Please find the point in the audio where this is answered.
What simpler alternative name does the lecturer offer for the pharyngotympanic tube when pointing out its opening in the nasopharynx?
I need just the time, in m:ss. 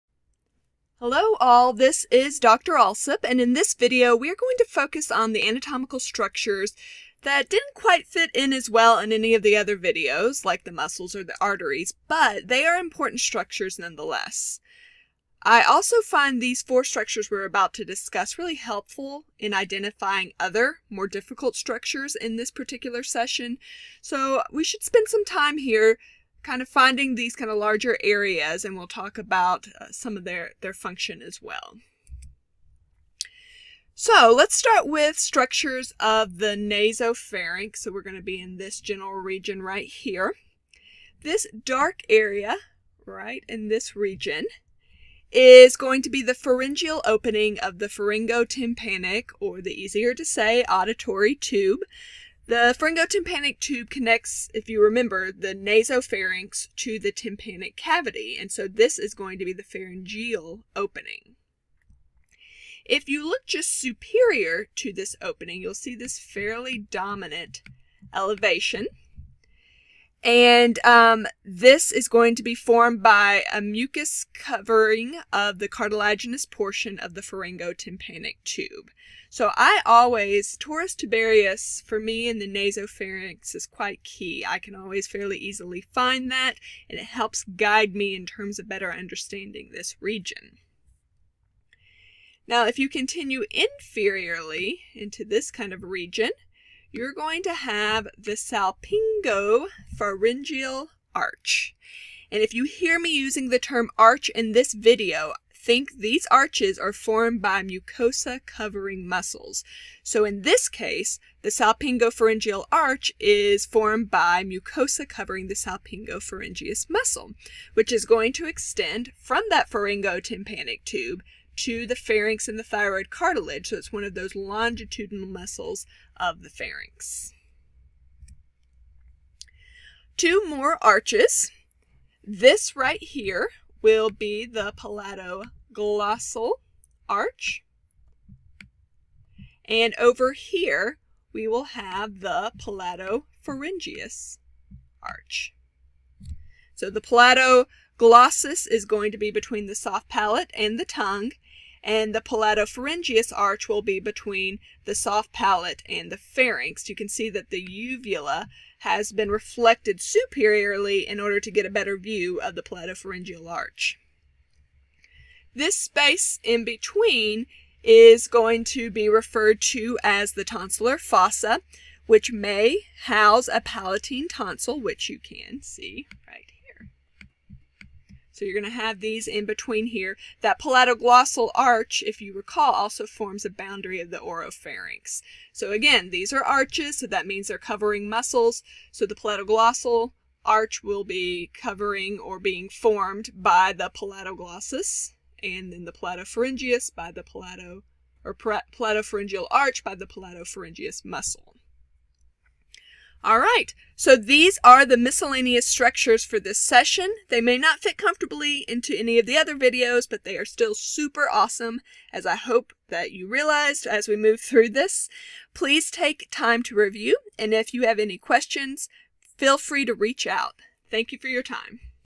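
0:50.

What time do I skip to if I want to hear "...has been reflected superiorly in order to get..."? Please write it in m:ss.
2:38.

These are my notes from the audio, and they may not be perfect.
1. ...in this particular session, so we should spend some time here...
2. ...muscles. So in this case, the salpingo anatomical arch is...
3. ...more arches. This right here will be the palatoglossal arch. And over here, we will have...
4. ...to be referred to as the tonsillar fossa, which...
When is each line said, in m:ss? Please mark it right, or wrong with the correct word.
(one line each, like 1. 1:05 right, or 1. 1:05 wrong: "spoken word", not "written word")
1. 0:22 right
2. 1:49 wrong: "pharyngeal", not "anatomical"
3. 2:10 right
4. 2:48 right.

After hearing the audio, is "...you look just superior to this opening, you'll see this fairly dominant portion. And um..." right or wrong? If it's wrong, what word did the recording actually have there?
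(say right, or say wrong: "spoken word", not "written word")
wrong: "elevation", not "portion".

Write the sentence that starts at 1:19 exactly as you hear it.
So I always, torus tubarius for me in the nasopharynx is quite key.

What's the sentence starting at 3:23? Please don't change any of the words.
All right, so these are the miscellaneous structures for this session.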